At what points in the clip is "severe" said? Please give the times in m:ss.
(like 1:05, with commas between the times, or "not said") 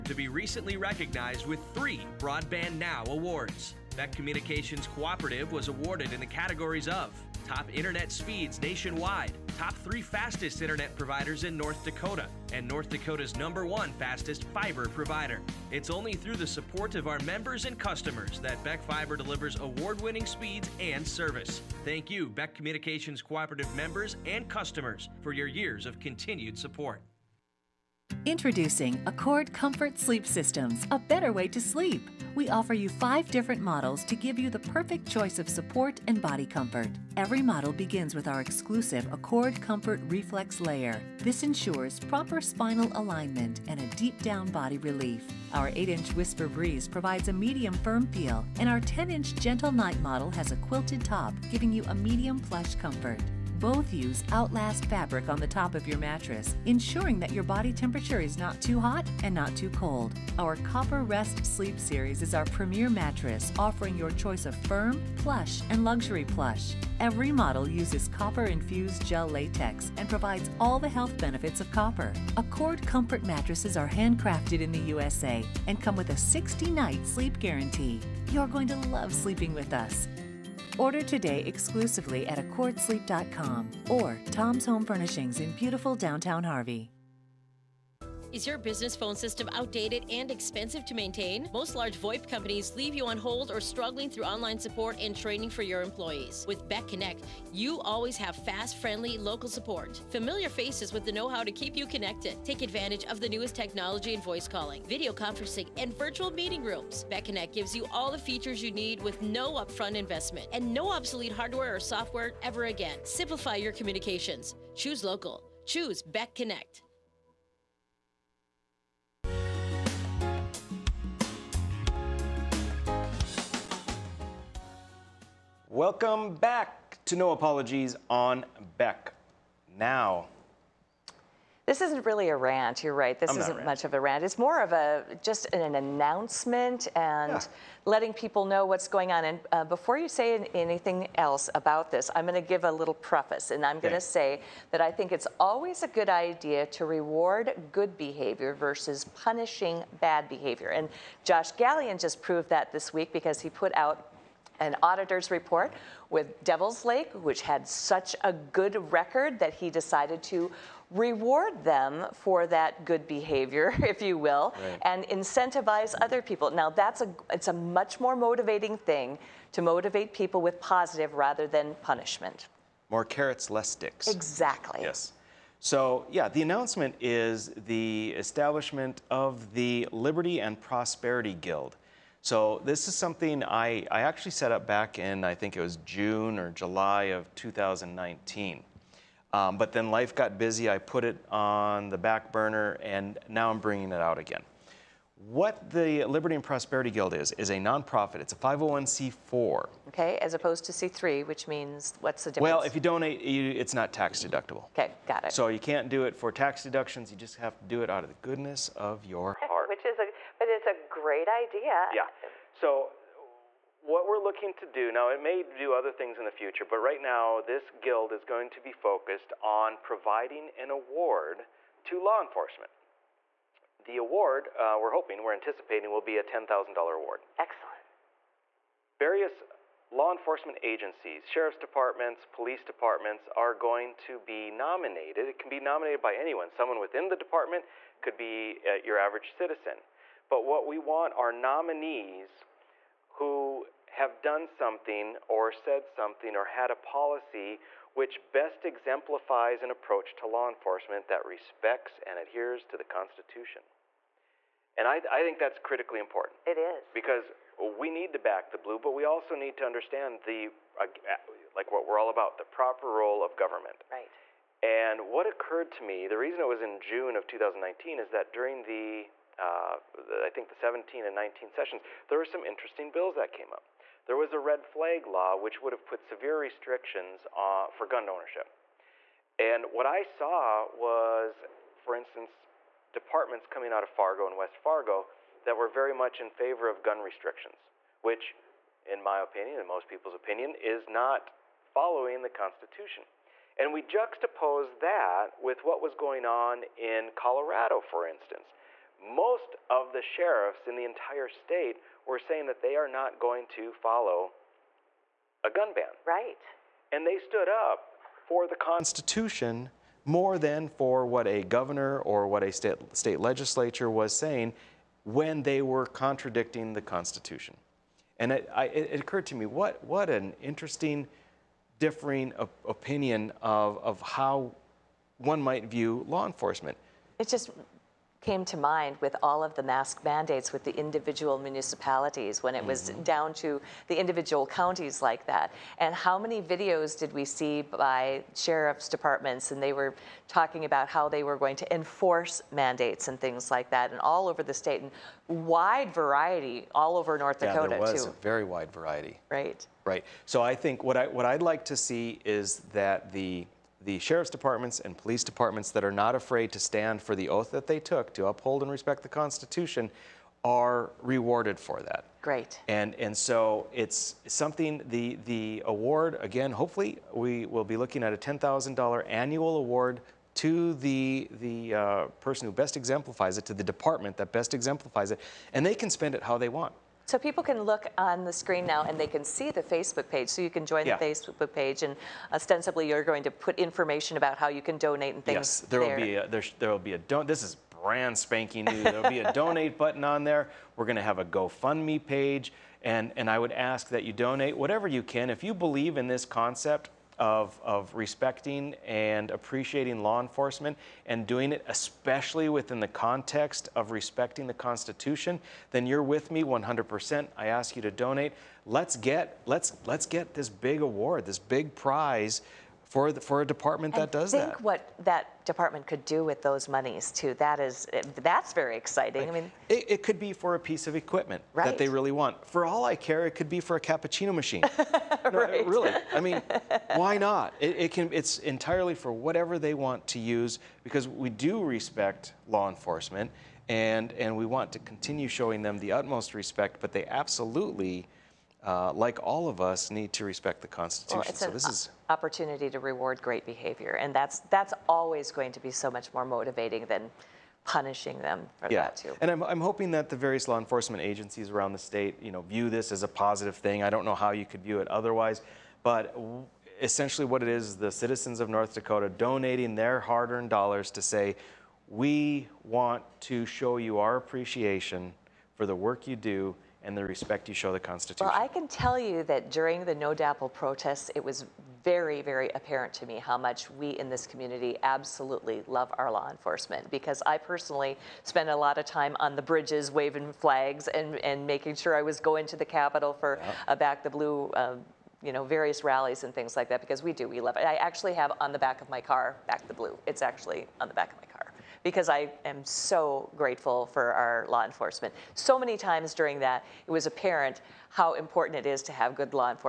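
4:36.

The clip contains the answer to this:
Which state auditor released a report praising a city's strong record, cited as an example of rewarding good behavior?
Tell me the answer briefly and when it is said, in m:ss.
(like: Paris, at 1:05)
Josh Gallion, at 2:31.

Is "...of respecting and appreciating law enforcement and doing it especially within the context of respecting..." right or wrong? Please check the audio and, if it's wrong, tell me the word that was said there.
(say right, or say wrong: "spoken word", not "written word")
right.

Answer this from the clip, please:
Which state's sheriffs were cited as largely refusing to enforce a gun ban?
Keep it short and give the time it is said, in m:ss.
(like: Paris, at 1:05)
Colorado, at 4:57.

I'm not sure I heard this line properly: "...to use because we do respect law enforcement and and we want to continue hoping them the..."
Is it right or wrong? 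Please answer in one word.
wrong.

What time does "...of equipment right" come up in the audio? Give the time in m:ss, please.
7:00.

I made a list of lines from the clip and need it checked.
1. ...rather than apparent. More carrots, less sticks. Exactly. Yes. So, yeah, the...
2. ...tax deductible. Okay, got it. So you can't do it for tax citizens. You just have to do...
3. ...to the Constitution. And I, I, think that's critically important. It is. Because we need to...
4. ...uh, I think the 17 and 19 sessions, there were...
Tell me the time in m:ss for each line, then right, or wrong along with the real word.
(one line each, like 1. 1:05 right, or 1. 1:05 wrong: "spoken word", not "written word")
1. 2:51 wrong: "punishment", not "apparent"
2. 3:23 wrong: "deductions", not "citizens"
3. 4:12 right
4. 4:29 right.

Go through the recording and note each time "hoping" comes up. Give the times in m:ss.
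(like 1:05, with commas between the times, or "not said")
3:44, 7:29.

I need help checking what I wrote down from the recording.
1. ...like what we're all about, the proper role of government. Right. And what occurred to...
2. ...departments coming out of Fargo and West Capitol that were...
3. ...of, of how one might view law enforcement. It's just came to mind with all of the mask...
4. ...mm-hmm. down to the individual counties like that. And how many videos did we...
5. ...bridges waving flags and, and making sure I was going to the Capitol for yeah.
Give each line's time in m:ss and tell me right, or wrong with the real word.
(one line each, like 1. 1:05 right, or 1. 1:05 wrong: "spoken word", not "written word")
1. 4:21 right
2. 4:42 wrong: "Fargo", not "Capitol"
3. 5:23 right
4. 5:32 right
5. 7:59 right.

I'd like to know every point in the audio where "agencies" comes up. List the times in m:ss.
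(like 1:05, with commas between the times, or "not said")
3:50, 7:31.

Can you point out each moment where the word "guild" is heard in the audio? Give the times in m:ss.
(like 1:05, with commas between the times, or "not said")
3:01, 3:16, 3:37.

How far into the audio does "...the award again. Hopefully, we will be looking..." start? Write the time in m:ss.
6:05.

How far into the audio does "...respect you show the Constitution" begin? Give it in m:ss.
7:47.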